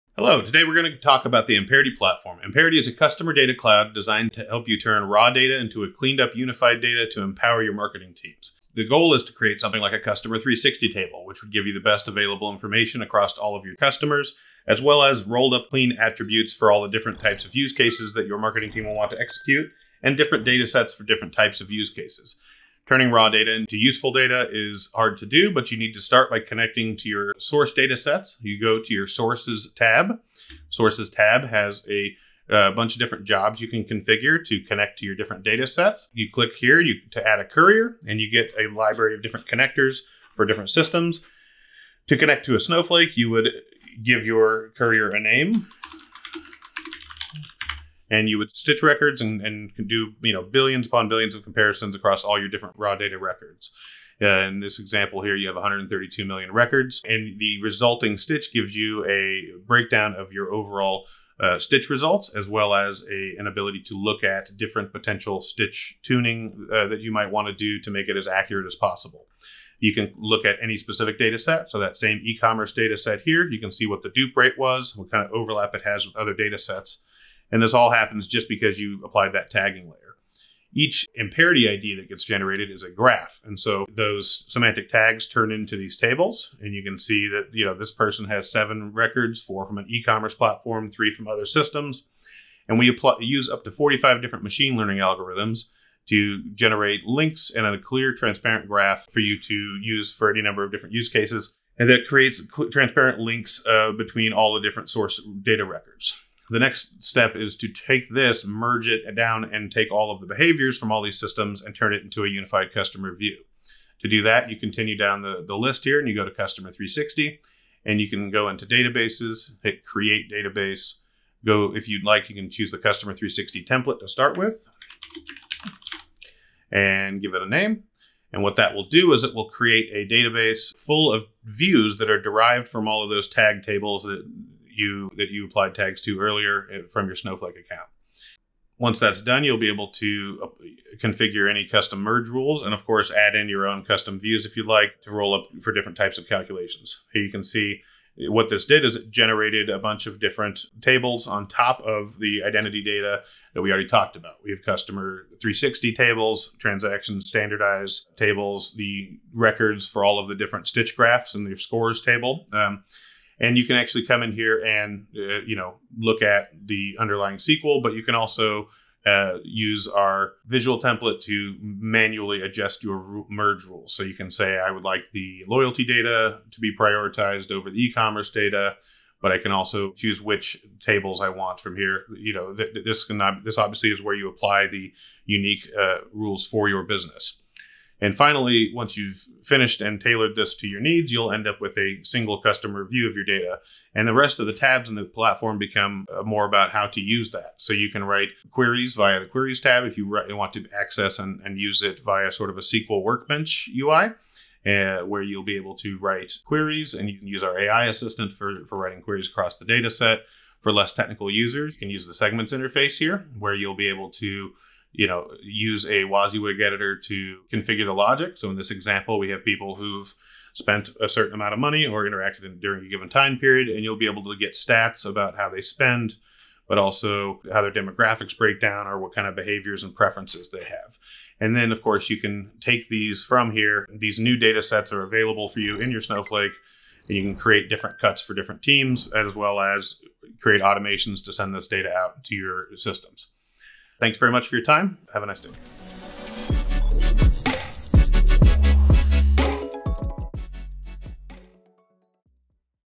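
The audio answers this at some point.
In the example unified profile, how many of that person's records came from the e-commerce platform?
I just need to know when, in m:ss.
1:29.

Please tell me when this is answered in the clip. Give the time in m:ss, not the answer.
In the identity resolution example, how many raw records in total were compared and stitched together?
0:55.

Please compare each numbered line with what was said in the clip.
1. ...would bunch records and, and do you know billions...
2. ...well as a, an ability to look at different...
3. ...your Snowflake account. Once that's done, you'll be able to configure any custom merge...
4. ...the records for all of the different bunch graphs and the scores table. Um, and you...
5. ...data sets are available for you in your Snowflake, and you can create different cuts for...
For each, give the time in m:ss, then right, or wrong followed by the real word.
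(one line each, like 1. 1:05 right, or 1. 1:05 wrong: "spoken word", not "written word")
1. 0:48 wrong: "stitch", not "bunch"
2. 1:02 right
3. 2:17 right
4. 2:38 wrong: "stitch", not "bunch"
5. 3:54 right.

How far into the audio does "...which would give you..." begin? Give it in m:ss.
0:11.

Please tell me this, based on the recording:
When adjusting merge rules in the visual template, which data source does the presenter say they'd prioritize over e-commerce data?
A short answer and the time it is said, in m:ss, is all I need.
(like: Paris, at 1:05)
loyalty data, at 2:55.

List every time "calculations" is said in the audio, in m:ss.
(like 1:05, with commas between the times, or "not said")
2:26.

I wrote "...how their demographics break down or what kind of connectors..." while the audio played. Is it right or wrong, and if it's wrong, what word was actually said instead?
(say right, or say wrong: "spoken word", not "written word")
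wrong: "behaviors", not "connectors".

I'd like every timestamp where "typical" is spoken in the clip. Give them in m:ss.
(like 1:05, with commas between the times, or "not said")
not said.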